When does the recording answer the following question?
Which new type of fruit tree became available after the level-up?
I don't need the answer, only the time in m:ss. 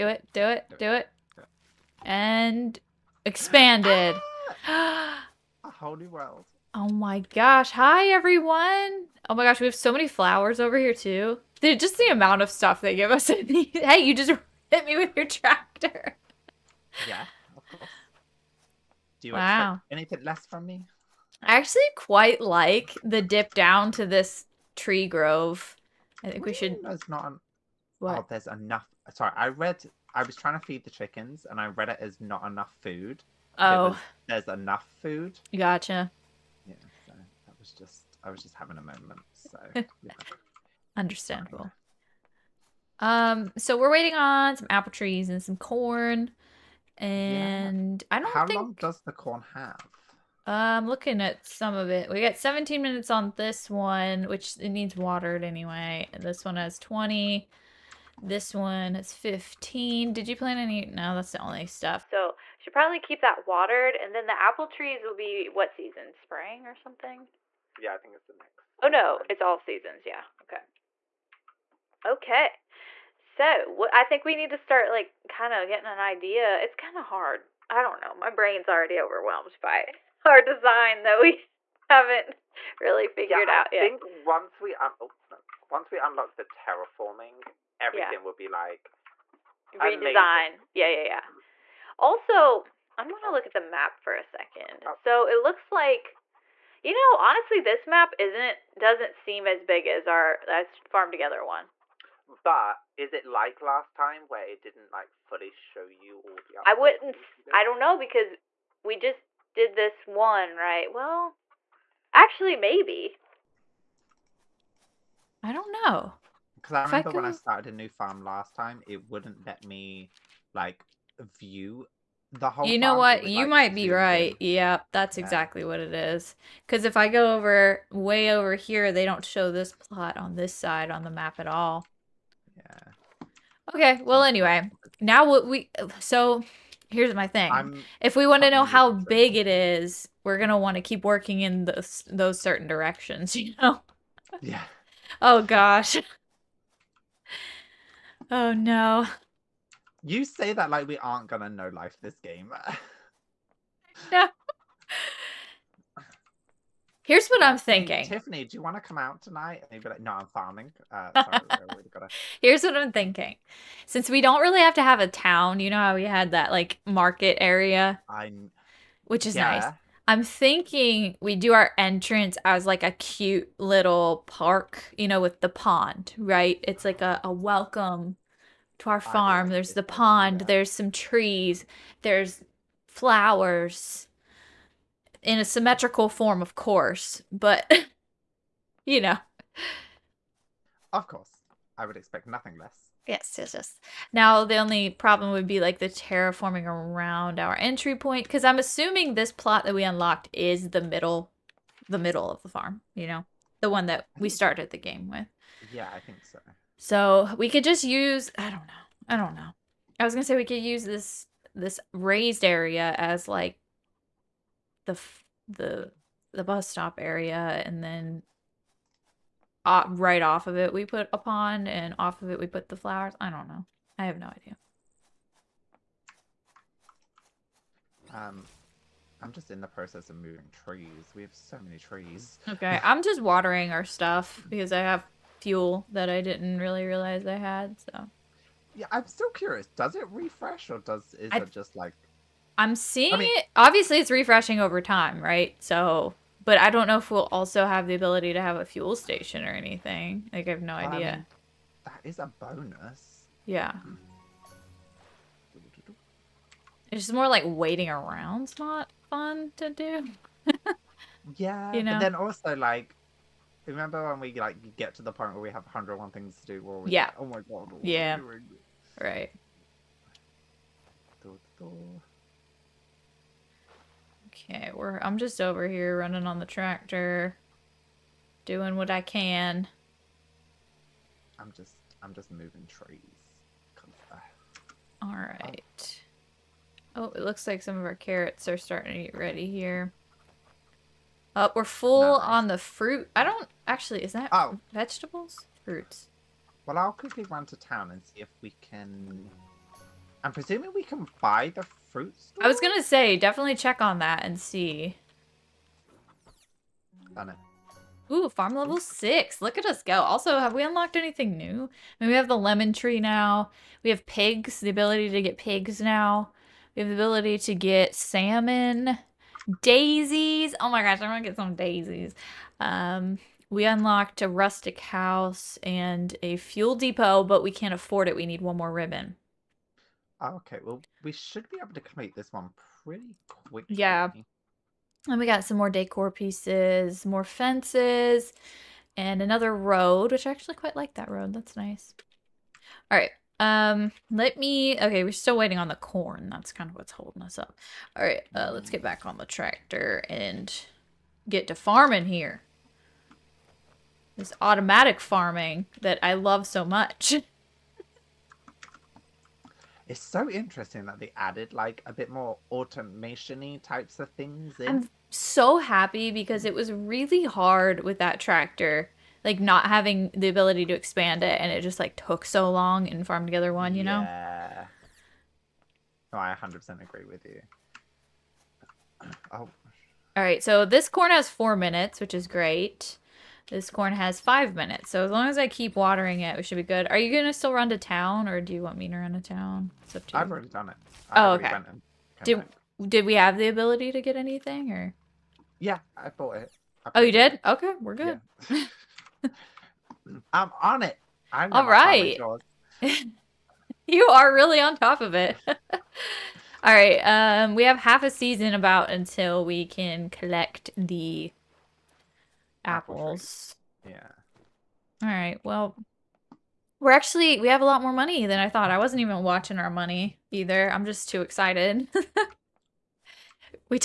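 5:12.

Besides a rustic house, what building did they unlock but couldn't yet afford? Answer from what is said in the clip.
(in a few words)
Fuel depot.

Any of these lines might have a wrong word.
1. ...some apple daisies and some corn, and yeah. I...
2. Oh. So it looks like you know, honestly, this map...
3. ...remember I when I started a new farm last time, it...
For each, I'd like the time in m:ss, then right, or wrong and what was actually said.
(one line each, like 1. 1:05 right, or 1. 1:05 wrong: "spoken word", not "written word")
1. 0:44 wrong: "trees", not "daisies"
2. 1:34 right
3. 1:56 right.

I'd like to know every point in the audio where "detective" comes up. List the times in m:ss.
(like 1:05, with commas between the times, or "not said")
not said.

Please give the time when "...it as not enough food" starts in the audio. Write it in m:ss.
0:31.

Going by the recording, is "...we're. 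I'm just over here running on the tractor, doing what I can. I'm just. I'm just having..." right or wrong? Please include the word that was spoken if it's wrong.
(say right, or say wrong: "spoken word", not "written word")
wrong: "moving", not "having".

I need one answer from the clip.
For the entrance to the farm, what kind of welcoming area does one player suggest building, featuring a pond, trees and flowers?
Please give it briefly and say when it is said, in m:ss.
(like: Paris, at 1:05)
A cute little park, at 2:52.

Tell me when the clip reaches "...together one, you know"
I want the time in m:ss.
6:13.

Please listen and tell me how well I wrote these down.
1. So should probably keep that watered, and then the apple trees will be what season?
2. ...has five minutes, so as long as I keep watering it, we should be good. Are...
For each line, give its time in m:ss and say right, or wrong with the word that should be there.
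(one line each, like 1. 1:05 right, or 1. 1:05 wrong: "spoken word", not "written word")
1. 1:02 right
2. 6:23 right.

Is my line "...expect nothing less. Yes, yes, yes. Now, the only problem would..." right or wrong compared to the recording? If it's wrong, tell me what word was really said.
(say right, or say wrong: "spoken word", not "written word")
right.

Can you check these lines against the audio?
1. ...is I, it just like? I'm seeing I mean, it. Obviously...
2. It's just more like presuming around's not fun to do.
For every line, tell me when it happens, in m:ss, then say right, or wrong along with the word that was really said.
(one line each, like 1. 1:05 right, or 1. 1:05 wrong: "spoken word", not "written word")
1. 4:01 right
2. 4:16 wrong: "waiting", not "presuming".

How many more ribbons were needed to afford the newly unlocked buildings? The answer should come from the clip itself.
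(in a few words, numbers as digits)
1.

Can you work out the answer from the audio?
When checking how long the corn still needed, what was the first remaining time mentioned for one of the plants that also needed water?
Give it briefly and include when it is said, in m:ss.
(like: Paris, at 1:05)
17 minutes, at 0:52.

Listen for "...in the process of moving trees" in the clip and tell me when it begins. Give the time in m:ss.
3:49.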